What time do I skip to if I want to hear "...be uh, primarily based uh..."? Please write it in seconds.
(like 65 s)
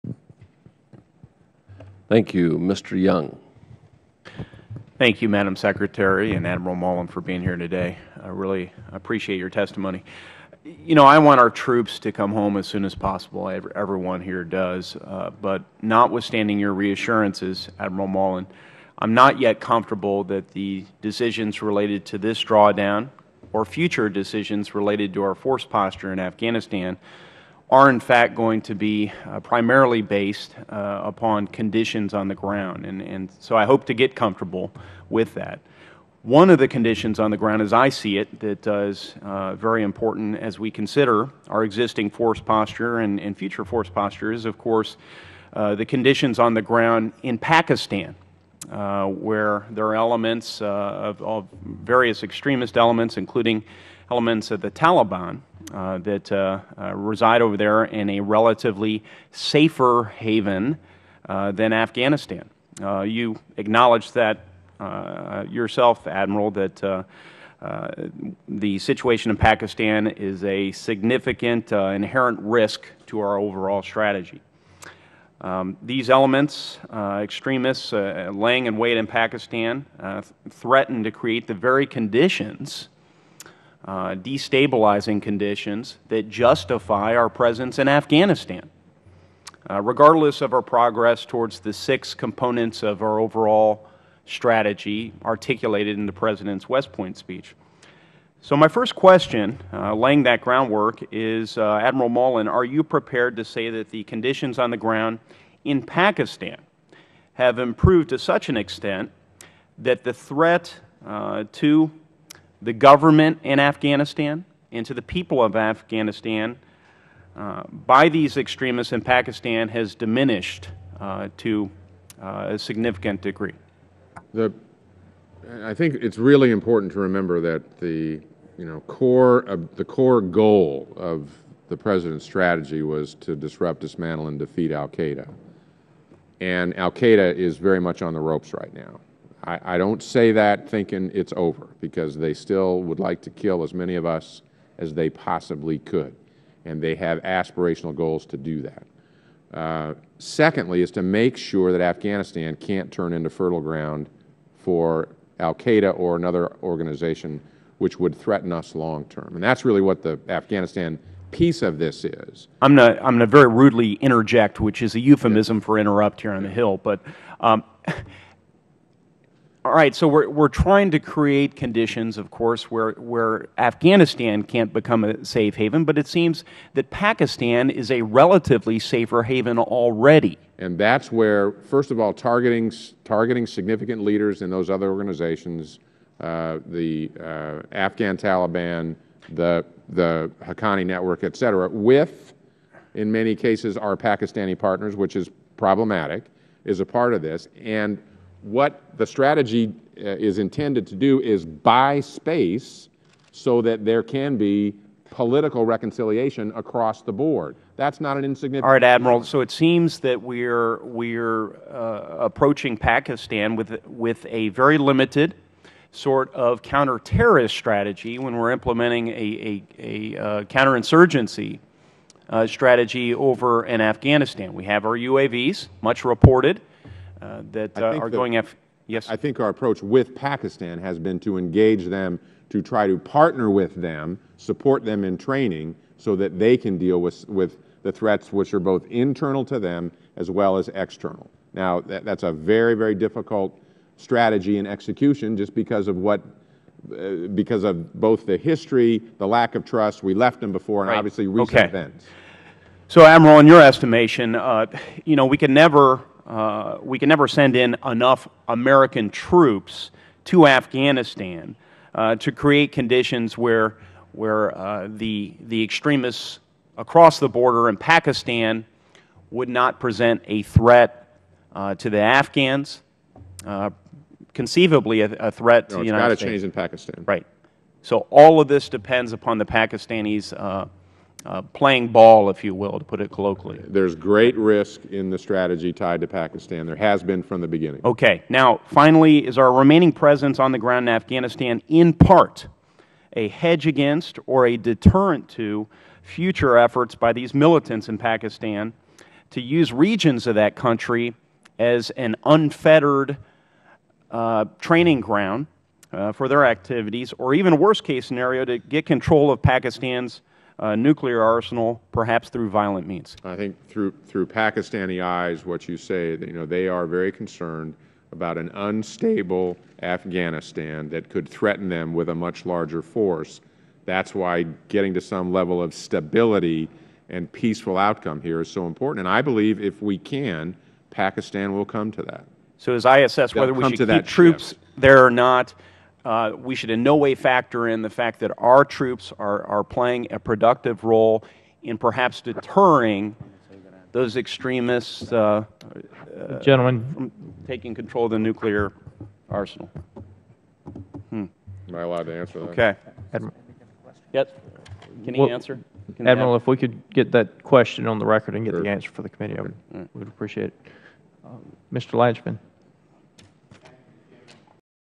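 28 s.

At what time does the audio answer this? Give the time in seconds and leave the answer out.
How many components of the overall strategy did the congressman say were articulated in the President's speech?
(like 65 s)
91 s.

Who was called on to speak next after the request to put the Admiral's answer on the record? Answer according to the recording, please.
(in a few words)
Mr. Lanchman.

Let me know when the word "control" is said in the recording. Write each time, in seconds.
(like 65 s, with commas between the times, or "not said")
308 s, 347 s.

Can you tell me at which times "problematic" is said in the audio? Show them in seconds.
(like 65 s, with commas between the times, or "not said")
195 s.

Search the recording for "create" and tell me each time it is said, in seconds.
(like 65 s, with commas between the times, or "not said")
81 s, 170 s, 262 s.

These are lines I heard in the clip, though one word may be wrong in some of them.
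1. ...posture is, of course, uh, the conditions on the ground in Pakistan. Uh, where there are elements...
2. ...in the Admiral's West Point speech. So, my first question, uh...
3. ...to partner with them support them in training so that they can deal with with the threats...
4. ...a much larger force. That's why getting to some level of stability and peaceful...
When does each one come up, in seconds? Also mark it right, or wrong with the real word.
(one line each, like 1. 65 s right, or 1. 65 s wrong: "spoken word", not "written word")
1. 43 s right
2. 95 s wrong: "President", not "Admiral"
3. 232 s right
4. 322 s right.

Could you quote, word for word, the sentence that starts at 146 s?
And they have aspirational goals to do that.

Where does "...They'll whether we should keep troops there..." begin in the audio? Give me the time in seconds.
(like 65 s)
333 s.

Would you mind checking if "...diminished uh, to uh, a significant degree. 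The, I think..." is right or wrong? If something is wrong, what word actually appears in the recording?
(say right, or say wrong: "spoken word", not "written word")
right.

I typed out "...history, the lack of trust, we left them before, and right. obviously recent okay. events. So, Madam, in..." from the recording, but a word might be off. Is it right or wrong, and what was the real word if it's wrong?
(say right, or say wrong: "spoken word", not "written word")
wrong: "Admiral", not "Madam".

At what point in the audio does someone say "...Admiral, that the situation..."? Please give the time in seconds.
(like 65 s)
66 s.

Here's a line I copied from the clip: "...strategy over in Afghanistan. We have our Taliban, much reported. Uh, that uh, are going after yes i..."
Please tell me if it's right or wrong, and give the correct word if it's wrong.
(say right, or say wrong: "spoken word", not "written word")
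wrong: "UAVs", not "Taliban".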